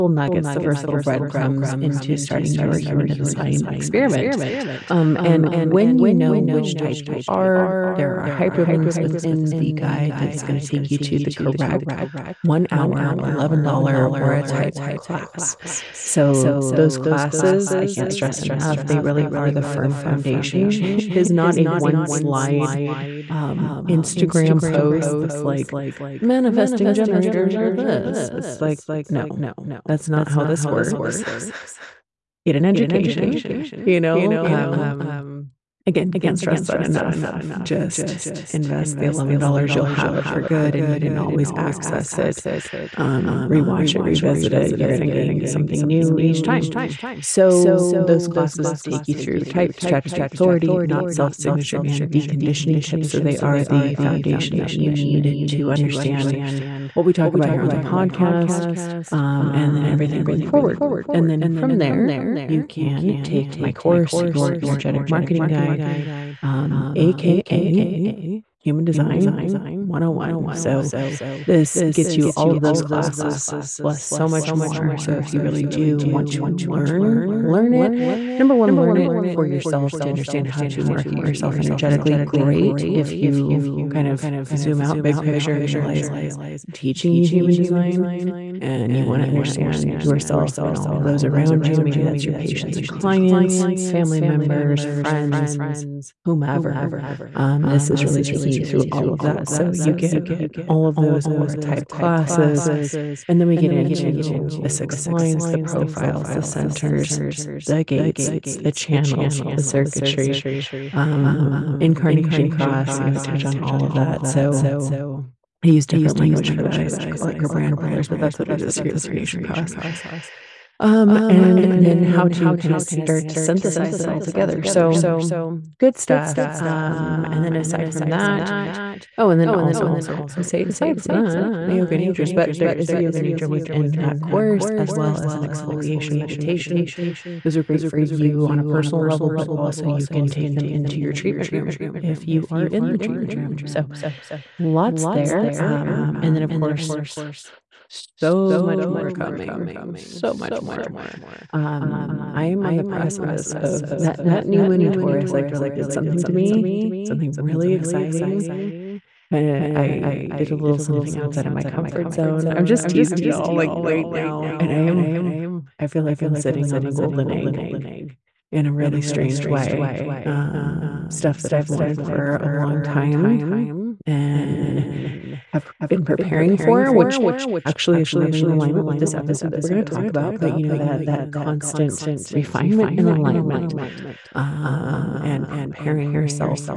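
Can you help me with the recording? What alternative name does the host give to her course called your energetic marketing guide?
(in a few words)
Human Design 101.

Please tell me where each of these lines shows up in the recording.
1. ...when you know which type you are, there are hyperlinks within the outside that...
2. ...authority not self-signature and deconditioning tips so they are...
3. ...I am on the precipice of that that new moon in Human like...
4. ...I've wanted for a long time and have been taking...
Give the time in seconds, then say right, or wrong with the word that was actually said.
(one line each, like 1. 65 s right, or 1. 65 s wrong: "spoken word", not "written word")
1. 5 s wrong: "guide", not "outside"
2. 50 s right
3. 152 s wrong: "Taurus", not "Human"
4. 171 s wrong: "preparing", not "taking".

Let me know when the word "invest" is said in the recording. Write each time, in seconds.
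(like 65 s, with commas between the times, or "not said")
38 s.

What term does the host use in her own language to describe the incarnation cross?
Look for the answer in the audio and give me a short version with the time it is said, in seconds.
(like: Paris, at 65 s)
brand pillars, at 117 s.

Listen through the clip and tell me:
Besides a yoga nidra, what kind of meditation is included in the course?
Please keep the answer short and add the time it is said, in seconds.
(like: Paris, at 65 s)
exfoliation meditation, at 135 s.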